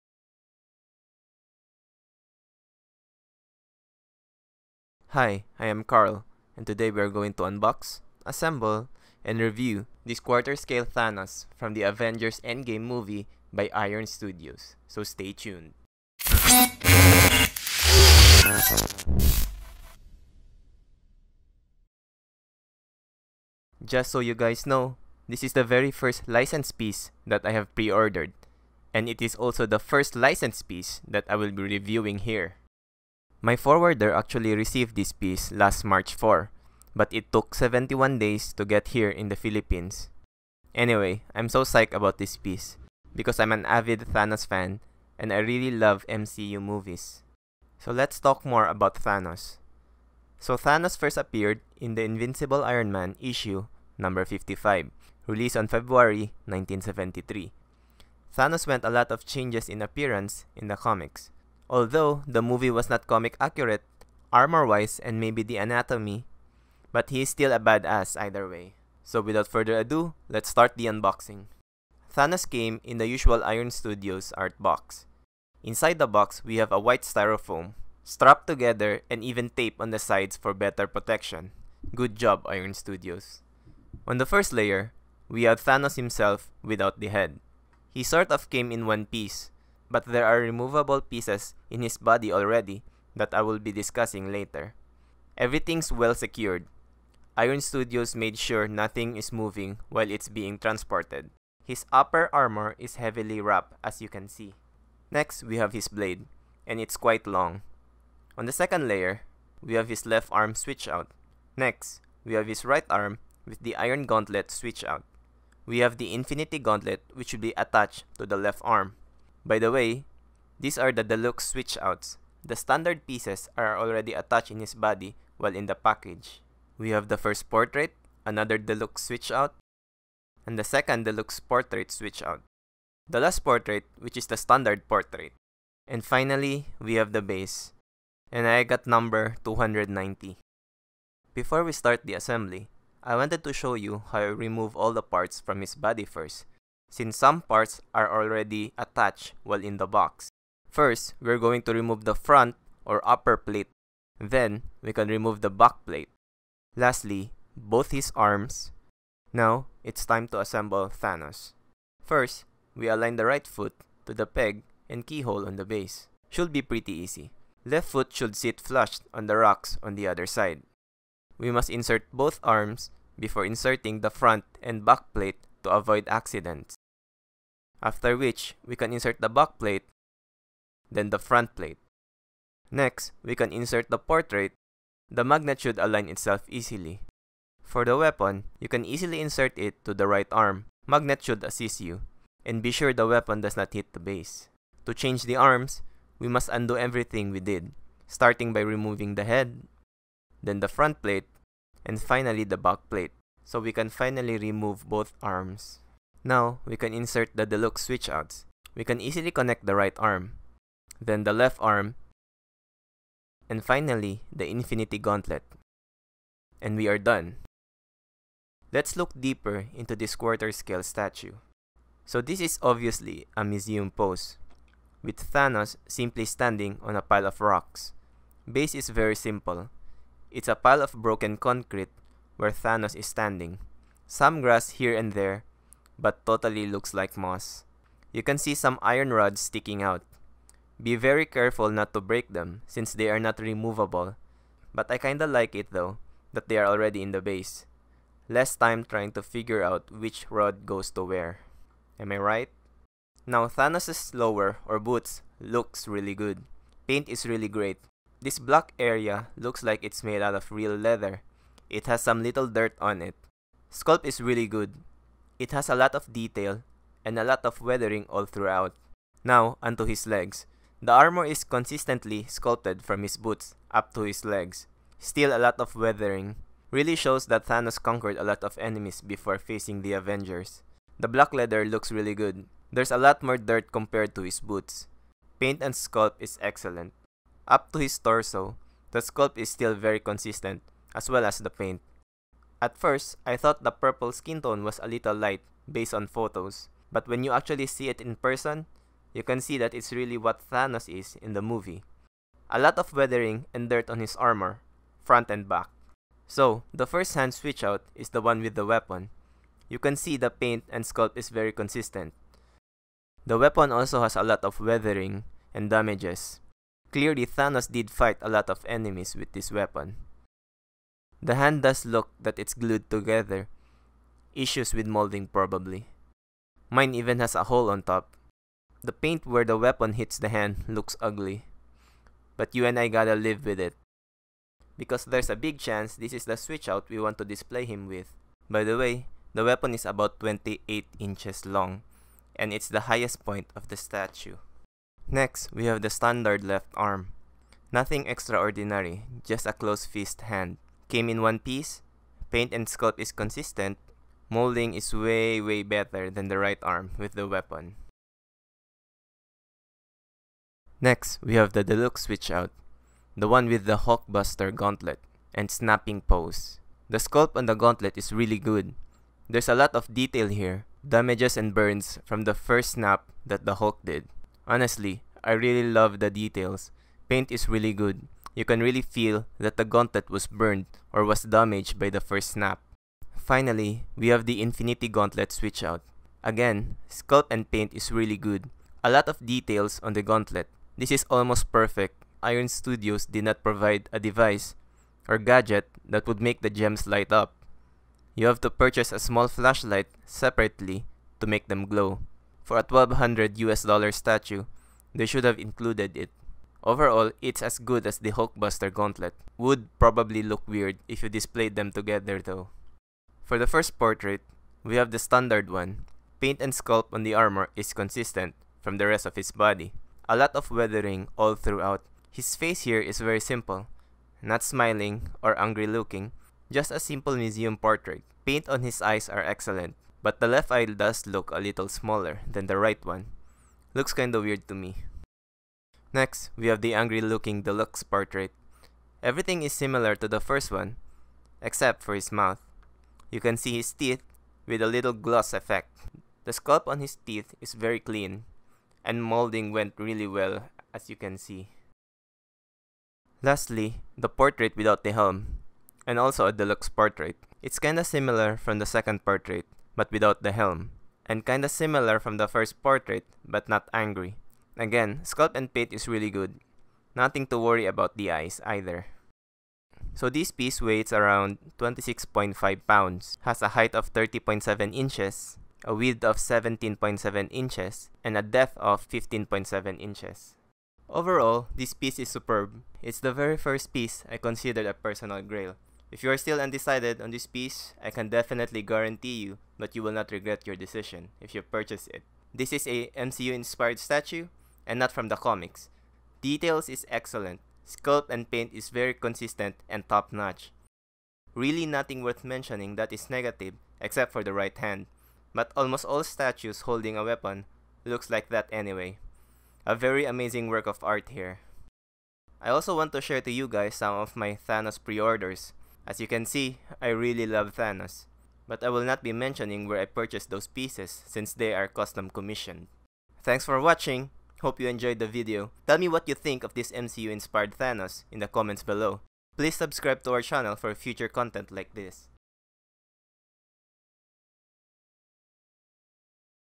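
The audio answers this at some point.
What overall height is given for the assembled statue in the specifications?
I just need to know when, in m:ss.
7:53.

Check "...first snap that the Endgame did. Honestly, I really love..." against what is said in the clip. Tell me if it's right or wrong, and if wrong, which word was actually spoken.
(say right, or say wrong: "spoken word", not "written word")
wrong: "Hulk", not "Endgame".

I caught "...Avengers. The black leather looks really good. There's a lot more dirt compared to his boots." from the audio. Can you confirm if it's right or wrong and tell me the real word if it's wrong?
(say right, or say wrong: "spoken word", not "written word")
right.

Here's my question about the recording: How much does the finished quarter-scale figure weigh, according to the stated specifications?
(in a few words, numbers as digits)
26.5 pounds.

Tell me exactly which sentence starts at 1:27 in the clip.
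He sort of came in one piece, but there are removable pieces in his body already that I will be discussing later.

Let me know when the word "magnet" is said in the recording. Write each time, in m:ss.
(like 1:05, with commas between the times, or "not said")
3:05, 3:10.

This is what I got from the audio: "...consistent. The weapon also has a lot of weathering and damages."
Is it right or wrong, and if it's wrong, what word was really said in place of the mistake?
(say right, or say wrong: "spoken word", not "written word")
right.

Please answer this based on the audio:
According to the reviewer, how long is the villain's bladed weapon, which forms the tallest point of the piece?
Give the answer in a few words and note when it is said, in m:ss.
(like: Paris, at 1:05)
28 inches, at 5:40.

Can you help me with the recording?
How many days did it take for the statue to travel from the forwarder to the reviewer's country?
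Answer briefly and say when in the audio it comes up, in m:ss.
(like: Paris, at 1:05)
71, at 0:37.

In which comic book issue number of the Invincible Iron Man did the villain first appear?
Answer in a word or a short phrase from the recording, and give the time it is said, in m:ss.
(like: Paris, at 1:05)
55, at 0:54.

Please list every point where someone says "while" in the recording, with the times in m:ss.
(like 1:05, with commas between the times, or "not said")
1:39, 2:05, 2:29.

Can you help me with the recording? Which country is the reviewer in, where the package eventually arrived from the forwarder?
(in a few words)
Philippines.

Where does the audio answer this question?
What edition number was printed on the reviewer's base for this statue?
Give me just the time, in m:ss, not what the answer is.
2:19.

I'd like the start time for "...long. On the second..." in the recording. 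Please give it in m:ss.
1:47.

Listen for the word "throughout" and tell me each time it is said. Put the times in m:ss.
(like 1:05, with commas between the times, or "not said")
4:28, 7:01.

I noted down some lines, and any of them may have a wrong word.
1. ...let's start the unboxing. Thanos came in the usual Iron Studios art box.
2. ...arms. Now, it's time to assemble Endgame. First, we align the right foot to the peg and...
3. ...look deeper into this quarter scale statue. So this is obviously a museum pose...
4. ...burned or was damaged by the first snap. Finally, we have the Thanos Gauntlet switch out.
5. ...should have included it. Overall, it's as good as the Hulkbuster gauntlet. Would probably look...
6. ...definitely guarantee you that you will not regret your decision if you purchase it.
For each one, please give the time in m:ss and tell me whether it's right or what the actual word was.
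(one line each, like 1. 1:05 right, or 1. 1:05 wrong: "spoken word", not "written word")
1. 1:10 right
2. 2:38 wrong: "Thanos", not "Endgame"
3. 3:38 right
4. 6:20 wrong: "Infinity", not "Thanos"
5. 6:45 right
6. 8:08 right.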